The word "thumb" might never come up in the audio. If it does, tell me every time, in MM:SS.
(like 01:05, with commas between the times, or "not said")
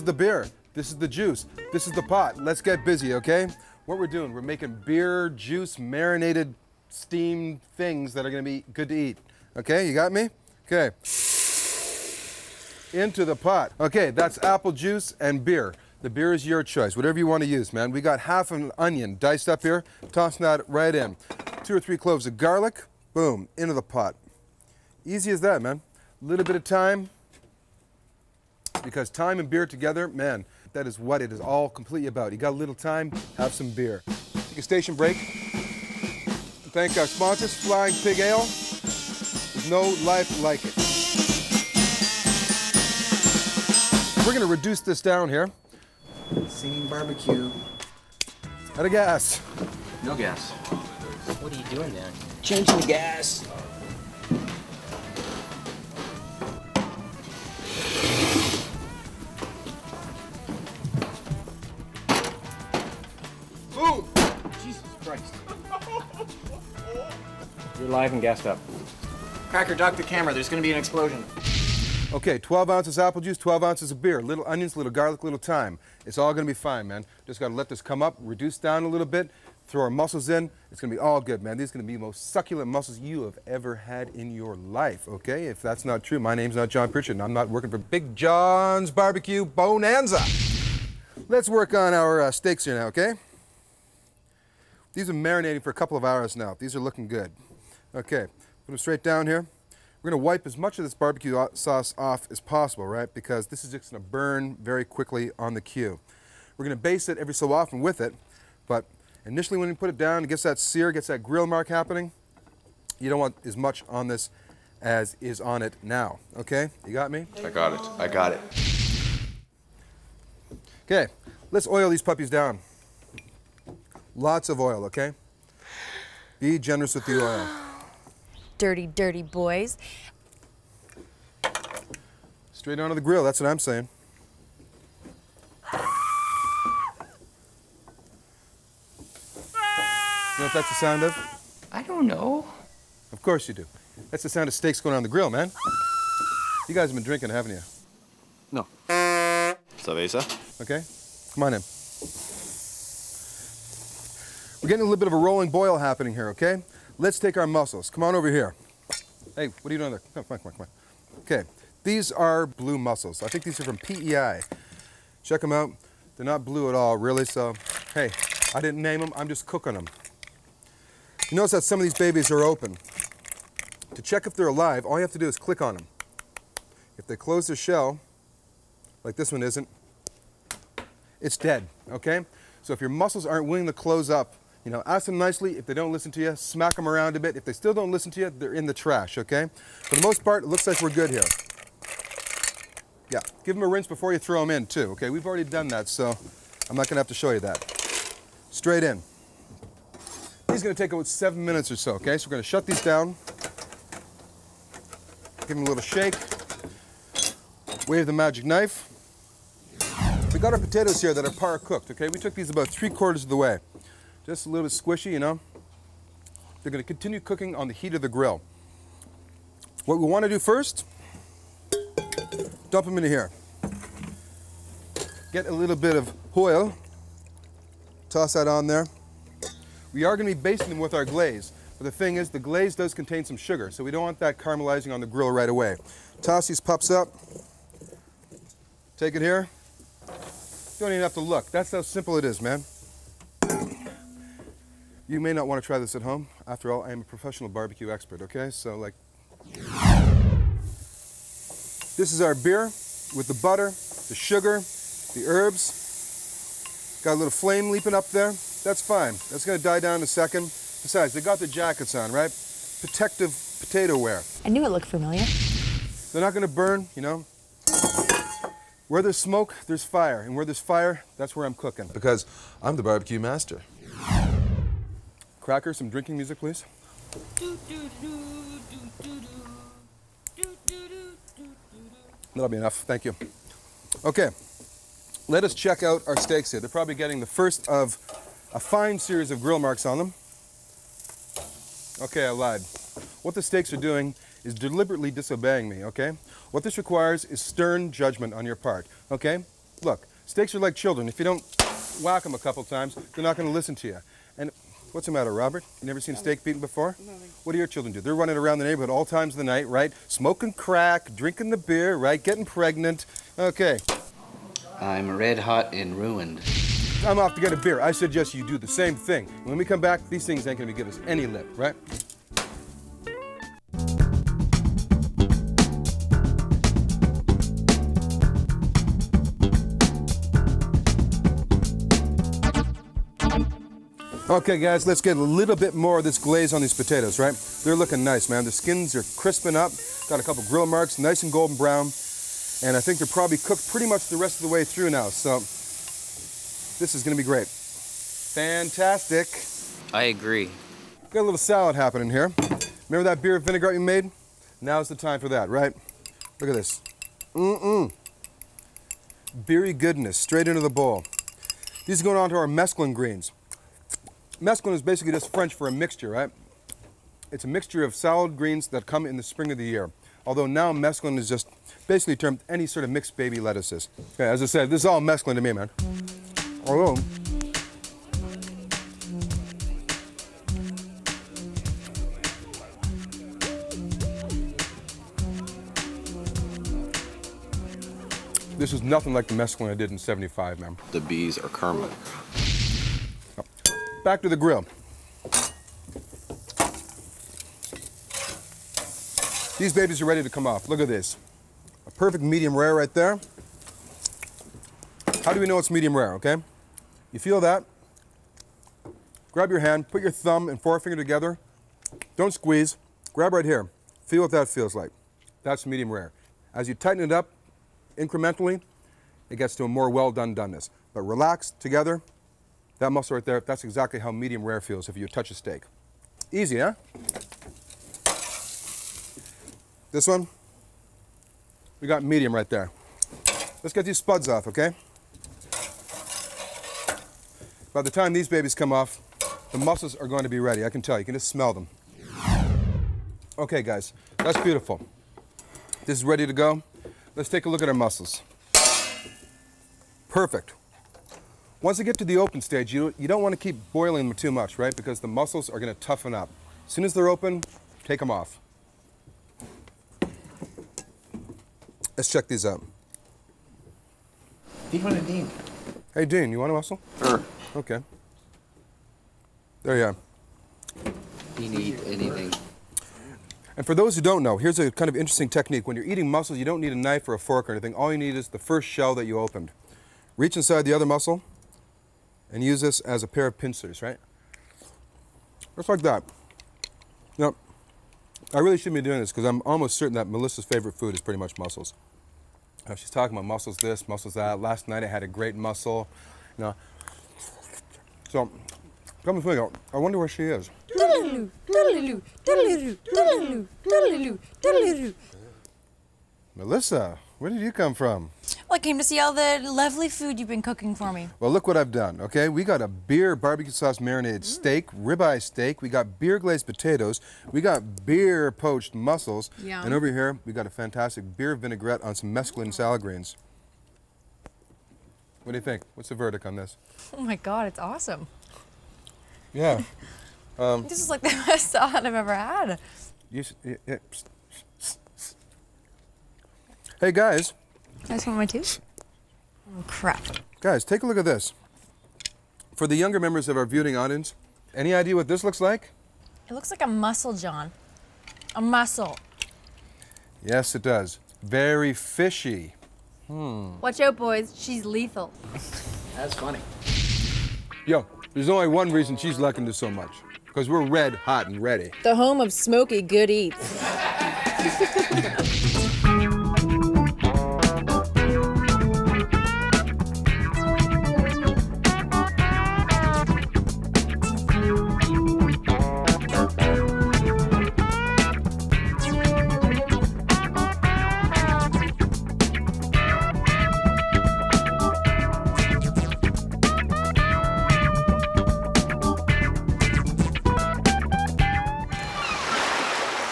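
06:50.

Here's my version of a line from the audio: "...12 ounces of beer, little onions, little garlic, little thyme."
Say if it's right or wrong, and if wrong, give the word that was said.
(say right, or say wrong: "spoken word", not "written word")
right.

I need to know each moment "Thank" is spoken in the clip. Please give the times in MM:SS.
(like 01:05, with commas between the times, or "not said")
00:36, 04:42.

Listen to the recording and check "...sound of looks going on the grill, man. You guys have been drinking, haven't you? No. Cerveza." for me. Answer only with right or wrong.
wrong.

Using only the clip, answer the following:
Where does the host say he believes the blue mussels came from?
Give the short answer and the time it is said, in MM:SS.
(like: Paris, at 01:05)
PEI, at 02:43.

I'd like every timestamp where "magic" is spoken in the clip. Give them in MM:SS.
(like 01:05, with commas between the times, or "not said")
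03:28.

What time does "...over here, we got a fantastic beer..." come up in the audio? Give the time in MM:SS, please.
08:39.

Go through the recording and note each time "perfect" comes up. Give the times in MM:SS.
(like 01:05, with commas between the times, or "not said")
06:41, 07:30.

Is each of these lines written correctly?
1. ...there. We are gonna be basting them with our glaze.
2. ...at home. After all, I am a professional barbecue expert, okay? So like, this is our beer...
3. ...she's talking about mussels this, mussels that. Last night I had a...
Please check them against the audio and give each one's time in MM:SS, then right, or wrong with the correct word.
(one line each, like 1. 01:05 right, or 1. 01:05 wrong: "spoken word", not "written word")
1. 03:48 right
2. 04:05 right
3. 08:12 right.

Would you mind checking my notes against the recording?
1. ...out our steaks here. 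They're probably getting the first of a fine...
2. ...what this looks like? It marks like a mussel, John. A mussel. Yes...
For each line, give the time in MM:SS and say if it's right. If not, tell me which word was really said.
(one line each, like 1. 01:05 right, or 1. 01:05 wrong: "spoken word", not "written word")
1. 04:45 right
2. 09:04 wrong: "looks", not "marks".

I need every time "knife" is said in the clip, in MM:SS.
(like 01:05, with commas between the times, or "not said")
03:28, 07:56.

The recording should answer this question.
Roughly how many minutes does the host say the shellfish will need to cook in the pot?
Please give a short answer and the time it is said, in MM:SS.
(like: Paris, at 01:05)
7, at 03:21.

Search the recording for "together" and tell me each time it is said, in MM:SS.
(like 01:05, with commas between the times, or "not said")
00:29, 06:50, 07:01.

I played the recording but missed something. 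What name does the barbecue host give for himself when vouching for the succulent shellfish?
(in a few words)
John Pritchard.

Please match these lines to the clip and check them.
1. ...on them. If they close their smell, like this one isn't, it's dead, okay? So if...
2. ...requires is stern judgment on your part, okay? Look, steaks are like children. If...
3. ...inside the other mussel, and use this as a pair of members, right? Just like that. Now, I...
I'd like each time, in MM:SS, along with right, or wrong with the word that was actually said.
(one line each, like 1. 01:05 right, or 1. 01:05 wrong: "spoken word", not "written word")
1. 02:55 wrong: "shell", not "smell"
2. 04:56 right
3. 08:00 wrong: "pincers", not "members".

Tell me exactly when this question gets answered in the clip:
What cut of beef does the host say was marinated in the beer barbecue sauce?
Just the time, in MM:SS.
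08:34.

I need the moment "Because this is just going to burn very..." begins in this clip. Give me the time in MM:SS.
01:43.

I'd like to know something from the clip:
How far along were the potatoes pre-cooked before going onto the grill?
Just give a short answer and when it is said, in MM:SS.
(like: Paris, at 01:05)
three quarters, at 03:32.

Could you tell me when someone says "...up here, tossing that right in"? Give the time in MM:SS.
00:19.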